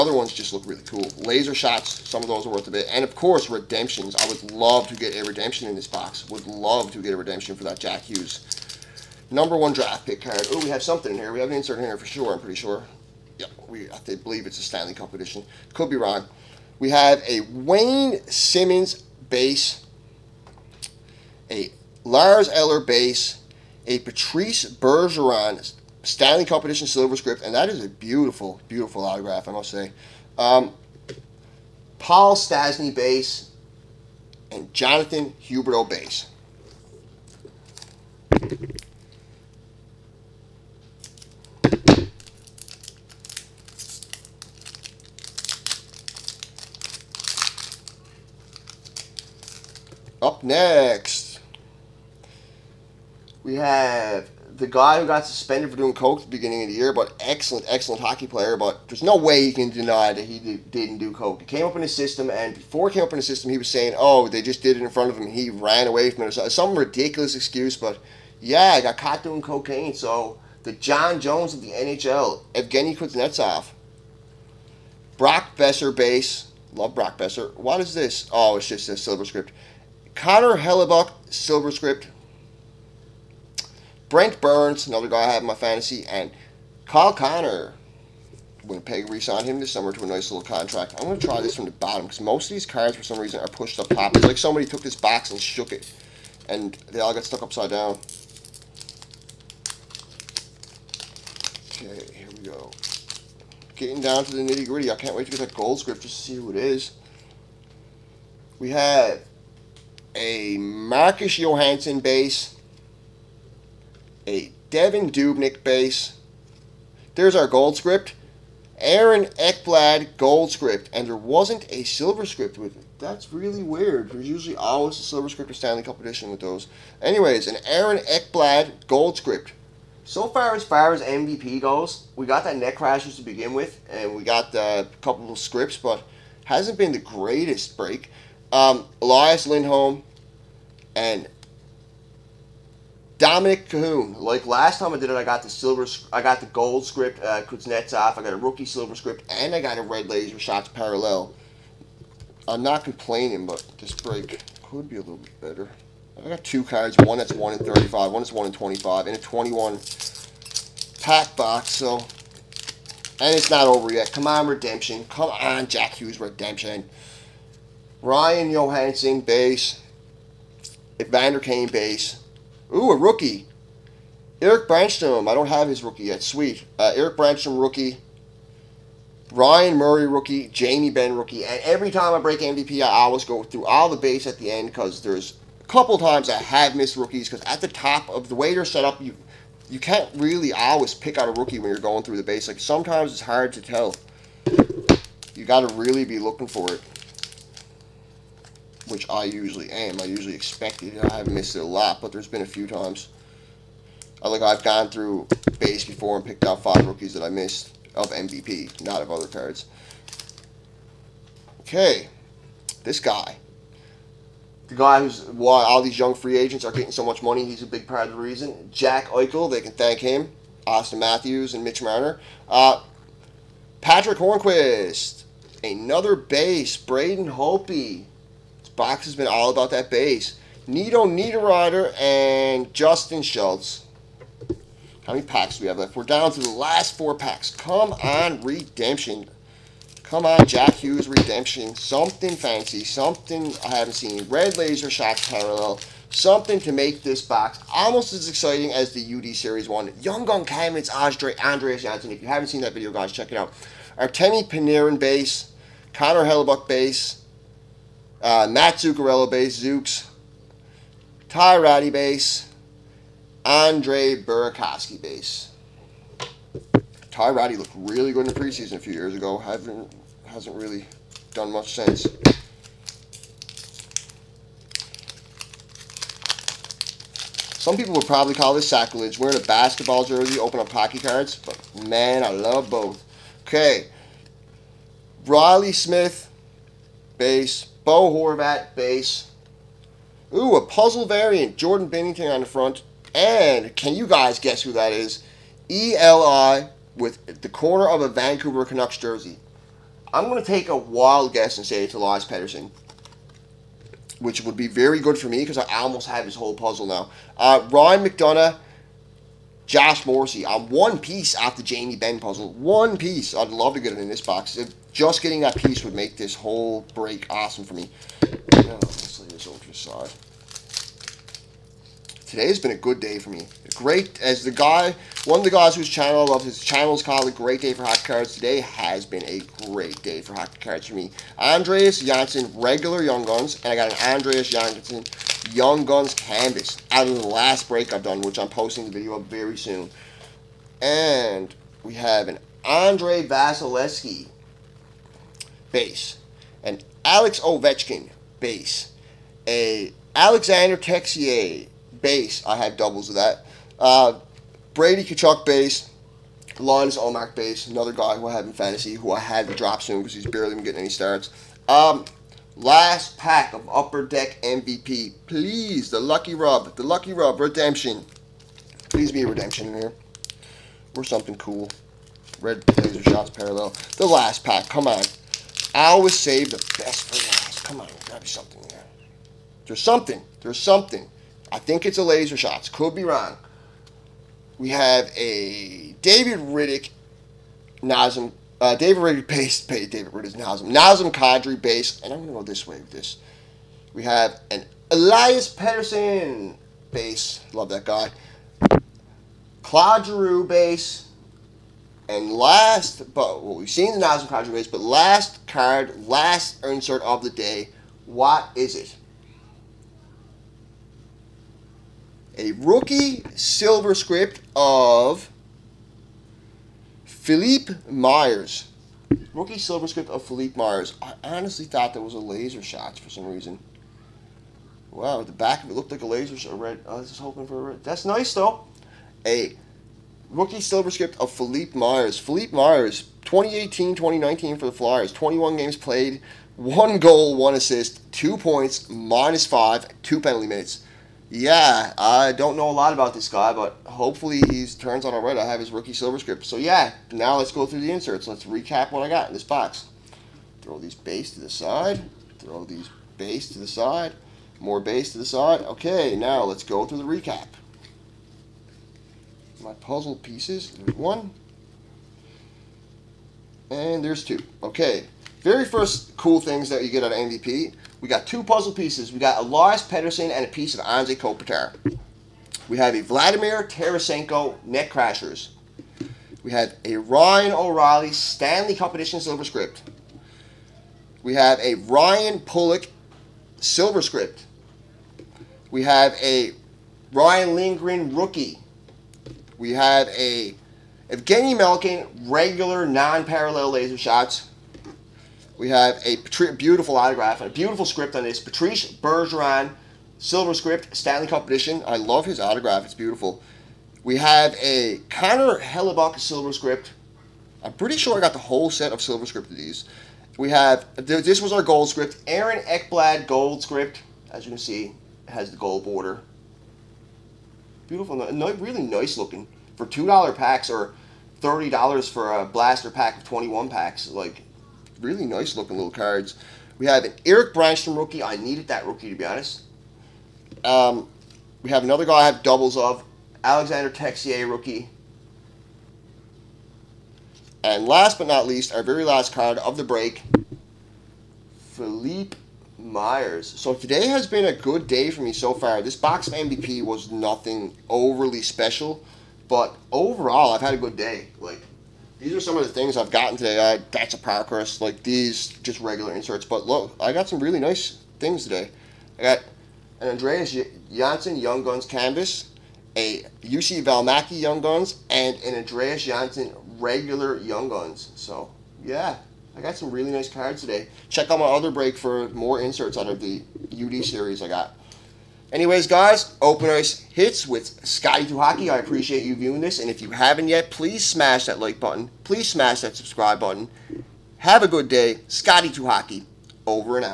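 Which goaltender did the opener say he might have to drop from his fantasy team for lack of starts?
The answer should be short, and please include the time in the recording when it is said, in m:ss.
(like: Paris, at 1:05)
Linus Ullmark, at 5:56.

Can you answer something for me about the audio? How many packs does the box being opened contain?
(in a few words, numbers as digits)
21.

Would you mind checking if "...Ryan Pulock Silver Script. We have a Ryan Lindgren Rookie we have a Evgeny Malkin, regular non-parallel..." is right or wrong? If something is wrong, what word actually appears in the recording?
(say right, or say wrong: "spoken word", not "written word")
right.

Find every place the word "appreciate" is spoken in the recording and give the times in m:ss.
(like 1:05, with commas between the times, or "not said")
9:38.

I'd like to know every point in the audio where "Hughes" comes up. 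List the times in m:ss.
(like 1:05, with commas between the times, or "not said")
0:08, 2:45, 4:00.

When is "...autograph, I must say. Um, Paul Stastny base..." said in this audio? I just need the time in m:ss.
0:29.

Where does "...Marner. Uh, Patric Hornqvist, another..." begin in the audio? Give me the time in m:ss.
3:41.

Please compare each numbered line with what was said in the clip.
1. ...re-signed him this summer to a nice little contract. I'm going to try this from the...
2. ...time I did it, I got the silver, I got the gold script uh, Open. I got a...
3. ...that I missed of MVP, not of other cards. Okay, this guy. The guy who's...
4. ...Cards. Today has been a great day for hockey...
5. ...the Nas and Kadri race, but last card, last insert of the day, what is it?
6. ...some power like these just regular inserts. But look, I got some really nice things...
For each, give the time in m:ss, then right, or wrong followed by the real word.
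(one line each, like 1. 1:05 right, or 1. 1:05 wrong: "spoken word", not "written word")
1. 1:29 right
2. 2:24 wrong: "Kuznetsov", not "Open"
3. 3:27 right
4. 5:28 right
5. 6:43 right
6. 9:14 right.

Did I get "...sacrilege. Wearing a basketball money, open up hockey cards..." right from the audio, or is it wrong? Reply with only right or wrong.
wrong.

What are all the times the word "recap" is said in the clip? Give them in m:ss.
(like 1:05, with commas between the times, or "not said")
7:28, 7:37.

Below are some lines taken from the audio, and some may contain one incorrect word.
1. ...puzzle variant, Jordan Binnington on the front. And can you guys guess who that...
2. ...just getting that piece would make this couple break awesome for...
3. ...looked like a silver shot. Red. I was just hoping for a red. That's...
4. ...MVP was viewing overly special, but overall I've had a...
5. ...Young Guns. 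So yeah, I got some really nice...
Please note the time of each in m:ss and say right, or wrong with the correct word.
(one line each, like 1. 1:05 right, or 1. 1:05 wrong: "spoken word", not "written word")
1. 4:50 right
2. 5:14 wrong: "whole", not "couple"
3. 7:05 wrong: "laser", not "silver"
4. 9:06 wrong: "nothing", not "viewing"
5. 9:27 right.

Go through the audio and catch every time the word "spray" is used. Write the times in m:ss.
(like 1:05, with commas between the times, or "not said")
not said.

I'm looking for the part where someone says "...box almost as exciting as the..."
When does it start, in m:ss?
4:07.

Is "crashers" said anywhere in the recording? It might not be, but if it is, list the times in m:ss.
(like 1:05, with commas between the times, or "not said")
2:12, 7:54.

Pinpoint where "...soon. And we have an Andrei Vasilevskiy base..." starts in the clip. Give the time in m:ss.
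5:39.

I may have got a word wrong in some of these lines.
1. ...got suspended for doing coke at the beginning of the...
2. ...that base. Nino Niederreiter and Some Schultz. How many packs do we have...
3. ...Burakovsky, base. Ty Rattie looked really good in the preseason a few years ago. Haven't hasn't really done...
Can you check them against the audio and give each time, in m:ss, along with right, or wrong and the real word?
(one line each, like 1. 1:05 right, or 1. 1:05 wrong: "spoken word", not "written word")
1. 0:55 right
2. 3:49 wrong: "Justin", not "Some"
3. 4:24 right.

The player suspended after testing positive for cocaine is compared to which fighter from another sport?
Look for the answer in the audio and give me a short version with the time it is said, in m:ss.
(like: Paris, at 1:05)
Jon Jones, at 1:10.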